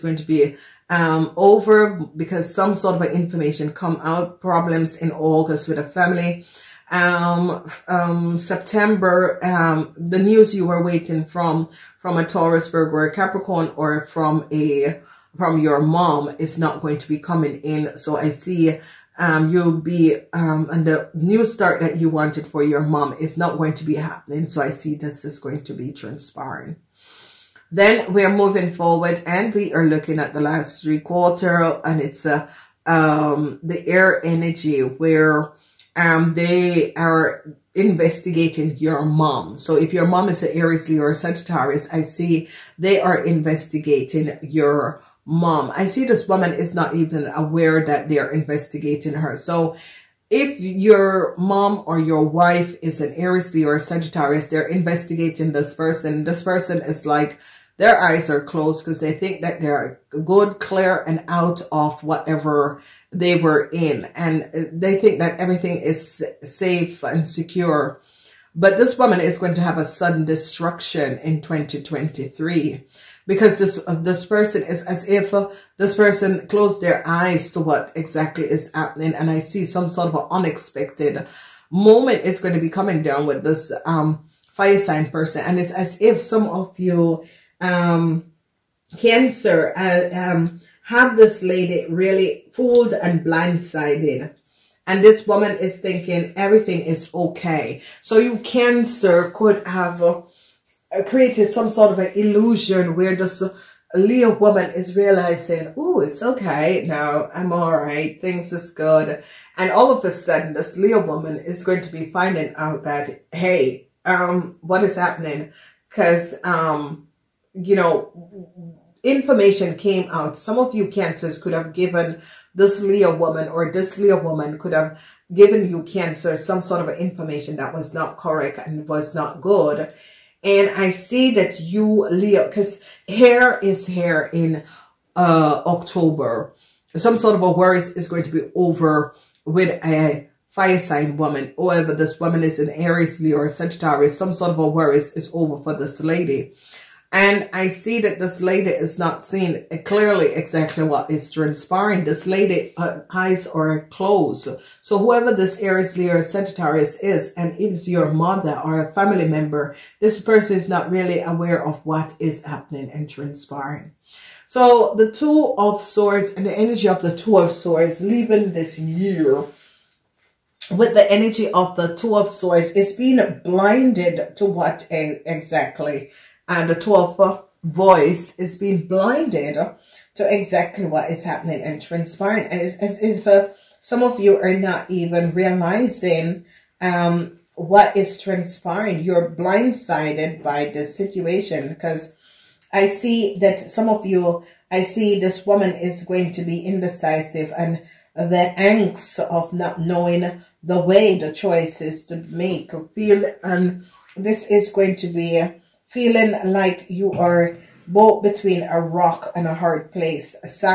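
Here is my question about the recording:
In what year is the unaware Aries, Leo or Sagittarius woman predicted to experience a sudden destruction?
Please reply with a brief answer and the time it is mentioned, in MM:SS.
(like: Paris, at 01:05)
2023, at 01:11.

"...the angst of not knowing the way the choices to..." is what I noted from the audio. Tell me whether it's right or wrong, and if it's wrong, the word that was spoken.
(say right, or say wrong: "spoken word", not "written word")
right.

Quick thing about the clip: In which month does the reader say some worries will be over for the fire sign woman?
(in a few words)
October.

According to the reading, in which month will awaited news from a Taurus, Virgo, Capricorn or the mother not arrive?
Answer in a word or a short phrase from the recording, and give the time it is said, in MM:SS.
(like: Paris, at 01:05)
September, at 00:08.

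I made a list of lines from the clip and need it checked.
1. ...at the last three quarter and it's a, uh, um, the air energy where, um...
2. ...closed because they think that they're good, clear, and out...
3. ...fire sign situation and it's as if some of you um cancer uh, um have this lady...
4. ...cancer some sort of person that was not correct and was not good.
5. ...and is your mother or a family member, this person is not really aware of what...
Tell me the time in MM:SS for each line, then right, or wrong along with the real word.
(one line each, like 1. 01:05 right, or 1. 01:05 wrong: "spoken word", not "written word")
1. 00:30 right
2. 00:58 right
3. 01:24 wrong: "person", not "situation"
4. 02:05 wrong: "information", not "person"
5. 02:37 right.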